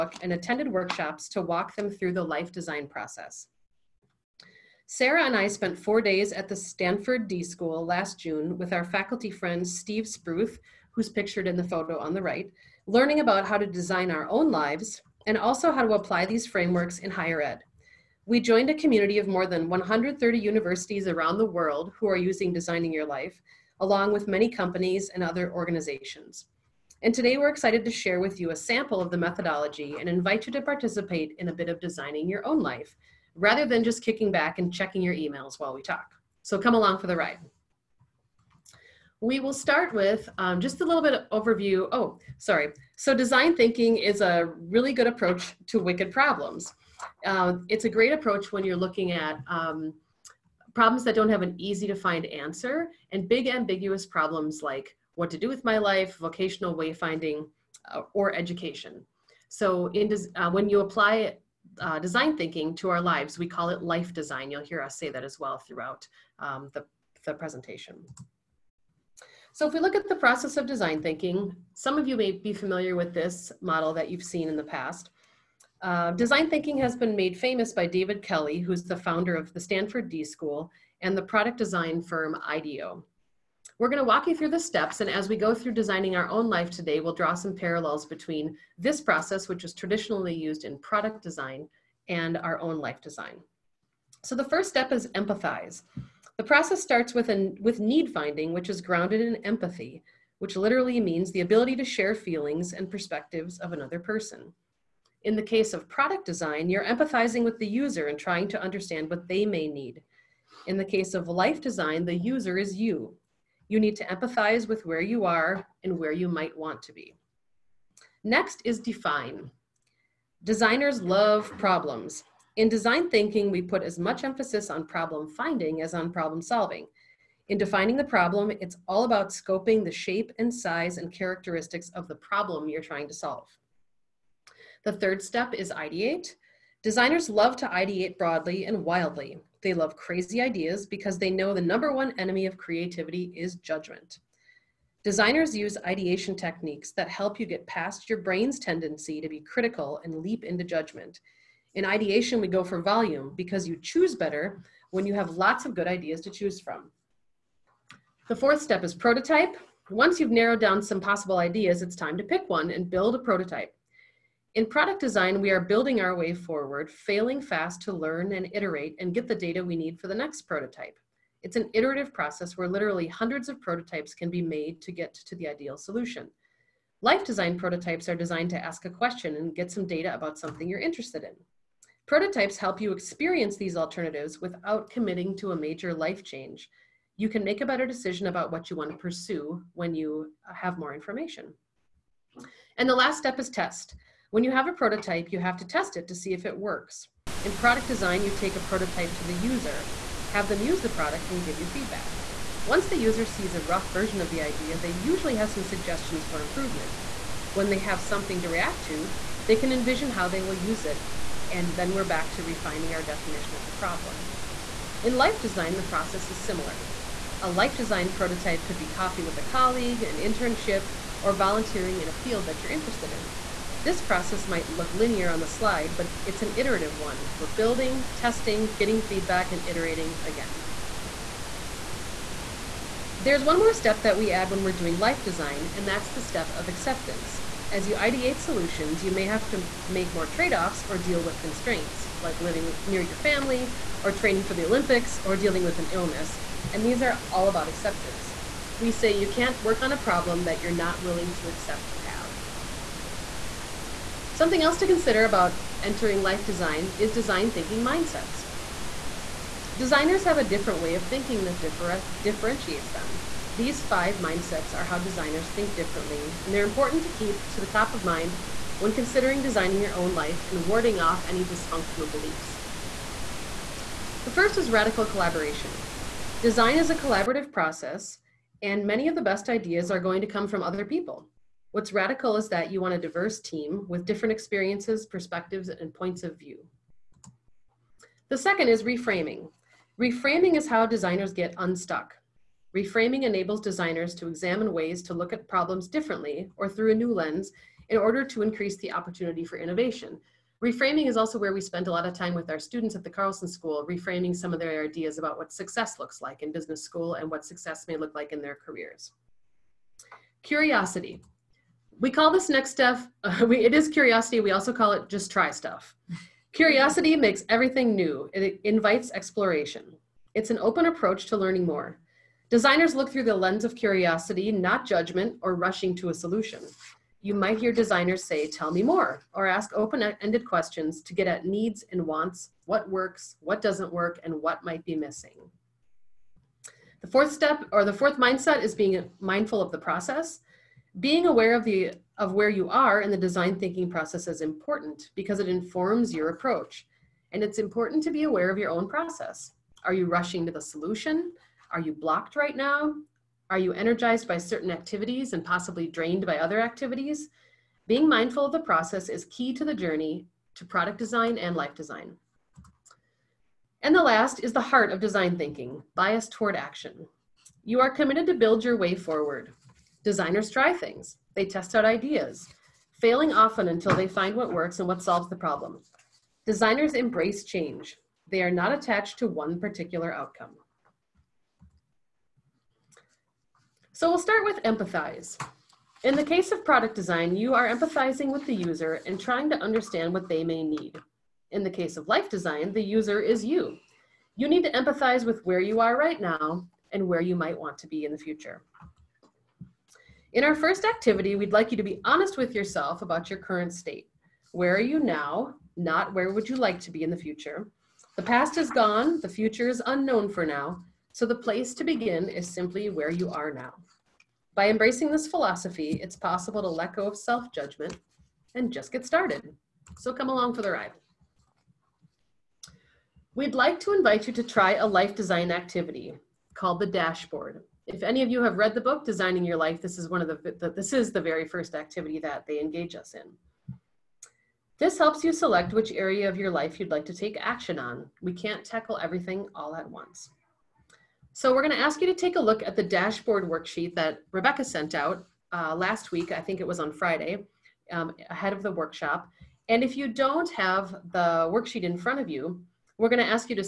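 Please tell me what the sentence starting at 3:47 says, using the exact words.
We're building, testing, getting feedback, and iterating again.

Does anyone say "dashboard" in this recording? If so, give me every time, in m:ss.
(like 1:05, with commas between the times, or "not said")
7:06, 7:22.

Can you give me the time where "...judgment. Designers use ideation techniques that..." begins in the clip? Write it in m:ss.
2:23.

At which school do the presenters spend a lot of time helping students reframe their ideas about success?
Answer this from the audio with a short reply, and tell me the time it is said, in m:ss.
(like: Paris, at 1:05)
Carlson School, at 5:03.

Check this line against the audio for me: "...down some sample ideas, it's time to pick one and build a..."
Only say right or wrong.
wrong.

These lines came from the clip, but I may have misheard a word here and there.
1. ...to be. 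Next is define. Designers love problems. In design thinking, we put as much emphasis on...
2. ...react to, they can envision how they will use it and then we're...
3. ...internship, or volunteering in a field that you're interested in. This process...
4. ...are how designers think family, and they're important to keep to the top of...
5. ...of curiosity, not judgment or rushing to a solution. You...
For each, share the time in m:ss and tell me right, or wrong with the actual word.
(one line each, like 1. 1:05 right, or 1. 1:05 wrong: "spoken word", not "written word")
1. 1:56 right
2. 3:28 right
3. 3:40 right
4. 4:24 wrong: "differently", not "family"
5. 5:23 right.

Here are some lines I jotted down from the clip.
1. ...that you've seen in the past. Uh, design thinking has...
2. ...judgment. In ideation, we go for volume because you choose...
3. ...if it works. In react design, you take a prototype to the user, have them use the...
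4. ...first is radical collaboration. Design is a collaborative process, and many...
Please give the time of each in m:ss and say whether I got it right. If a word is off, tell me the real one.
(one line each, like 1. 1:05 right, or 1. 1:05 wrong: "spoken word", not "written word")
1. 1:13 right
2. 2:30 right
3. 3:16 wrong: "product", not "react"
4. 4:34 right.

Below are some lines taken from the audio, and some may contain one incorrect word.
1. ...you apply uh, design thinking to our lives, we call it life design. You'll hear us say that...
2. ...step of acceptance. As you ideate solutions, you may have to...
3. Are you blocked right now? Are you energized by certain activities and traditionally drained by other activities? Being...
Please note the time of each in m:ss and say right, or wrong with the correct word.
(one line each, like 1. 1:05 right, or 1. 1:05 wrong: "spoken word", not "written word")
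1. 1:00 right
2. 3:56 right
3. 5:51 wrong: "possibly", not "traditionally".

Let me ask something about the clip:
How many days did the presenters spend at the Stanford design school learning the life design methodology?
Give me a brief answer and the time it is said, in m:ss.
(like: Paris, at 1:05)
4, at 0:05.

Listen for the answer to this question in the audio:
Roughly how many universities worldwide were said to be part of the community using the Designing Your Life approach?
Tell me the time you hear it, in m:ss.
0:19.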